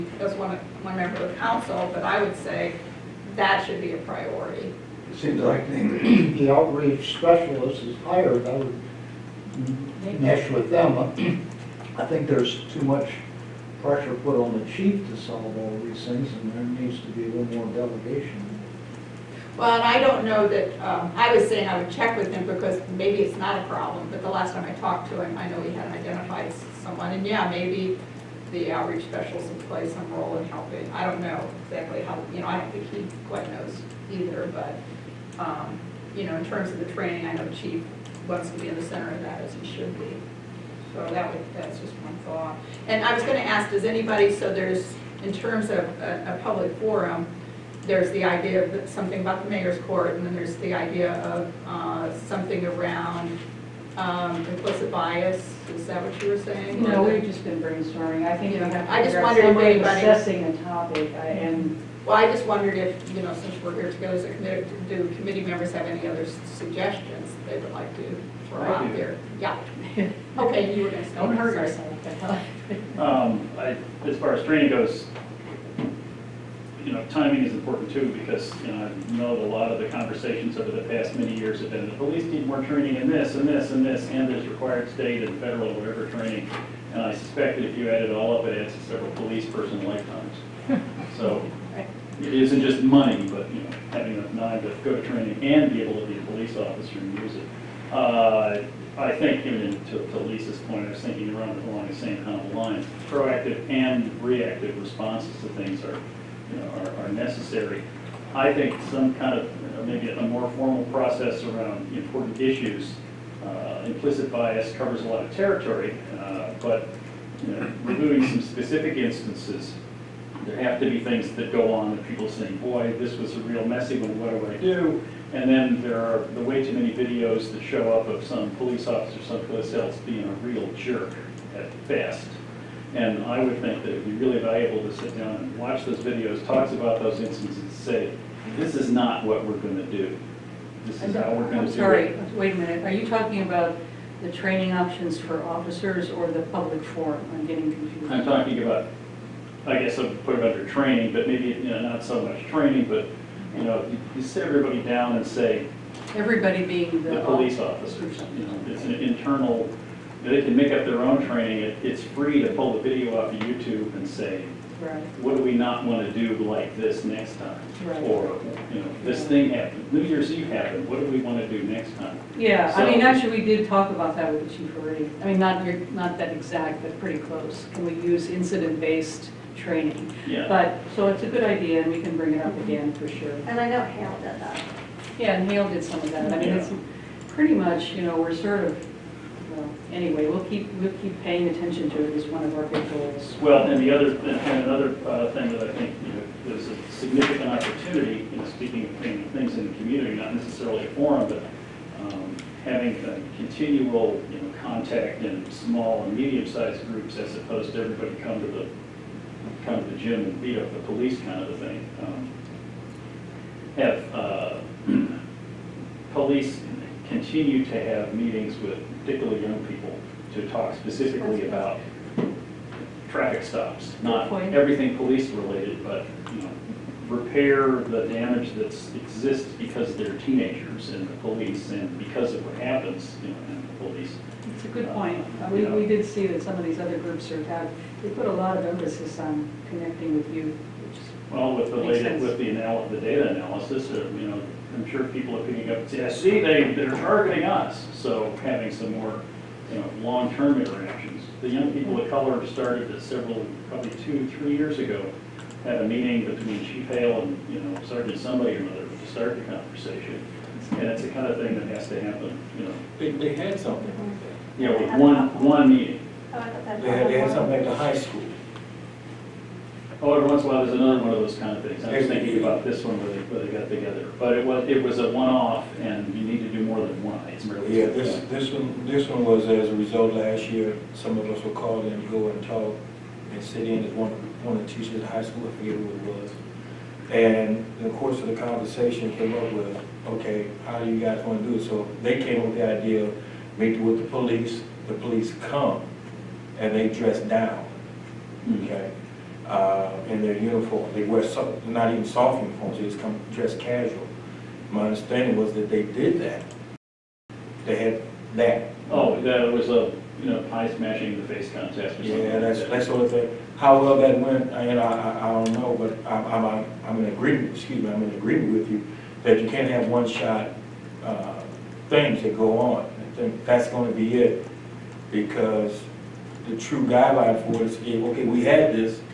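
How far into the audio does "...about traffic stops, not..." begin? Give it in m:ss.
3:41.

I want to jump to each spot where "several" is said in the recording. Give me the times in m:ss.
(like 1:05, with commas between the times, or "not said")
1:28, 4:13.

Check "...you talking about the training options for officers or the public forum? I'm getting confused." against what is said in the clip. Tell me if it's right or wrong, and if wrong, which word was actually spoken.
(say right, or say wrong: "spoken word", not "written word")
right.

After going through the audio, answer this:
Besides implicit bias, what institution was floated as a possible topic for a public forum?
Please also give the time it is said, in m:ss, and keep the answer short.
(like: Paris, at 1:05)
mayor's court, at 0:49.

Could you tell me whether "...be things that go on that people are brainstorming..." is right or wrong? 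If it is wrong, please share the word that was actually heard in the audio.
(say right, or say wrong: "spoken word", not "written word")
wrong: "saying", not "brainstorming".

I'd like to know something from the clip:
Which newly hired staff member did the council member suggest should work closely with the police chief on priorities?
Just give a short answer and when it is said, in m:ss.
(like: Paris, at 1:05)
outreach specialist, at 0:06.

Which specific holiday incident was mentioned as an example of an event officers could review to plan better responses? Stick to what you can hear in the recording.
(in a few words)
New Year's Eve.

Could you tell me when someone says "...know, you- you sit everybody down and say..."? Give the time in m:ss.
2:33.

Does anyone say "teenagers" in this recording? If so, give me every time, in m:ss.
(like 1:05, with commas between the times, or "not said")
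3:50.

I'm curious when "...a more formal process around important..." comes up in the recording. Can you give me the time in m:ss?
1:50.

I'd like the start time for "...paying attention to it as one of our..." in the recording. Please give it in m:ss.
3:11.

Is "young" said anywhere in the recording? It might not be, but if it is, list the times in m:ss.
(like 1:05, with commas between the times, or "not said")
3:39, 4:11.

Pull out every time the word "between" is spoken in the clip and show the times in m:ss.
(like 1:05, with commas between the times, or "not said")
4:16.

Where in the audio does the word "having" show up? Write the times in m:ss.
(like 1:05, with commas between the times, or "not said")
1:33, 3:22, 4:08.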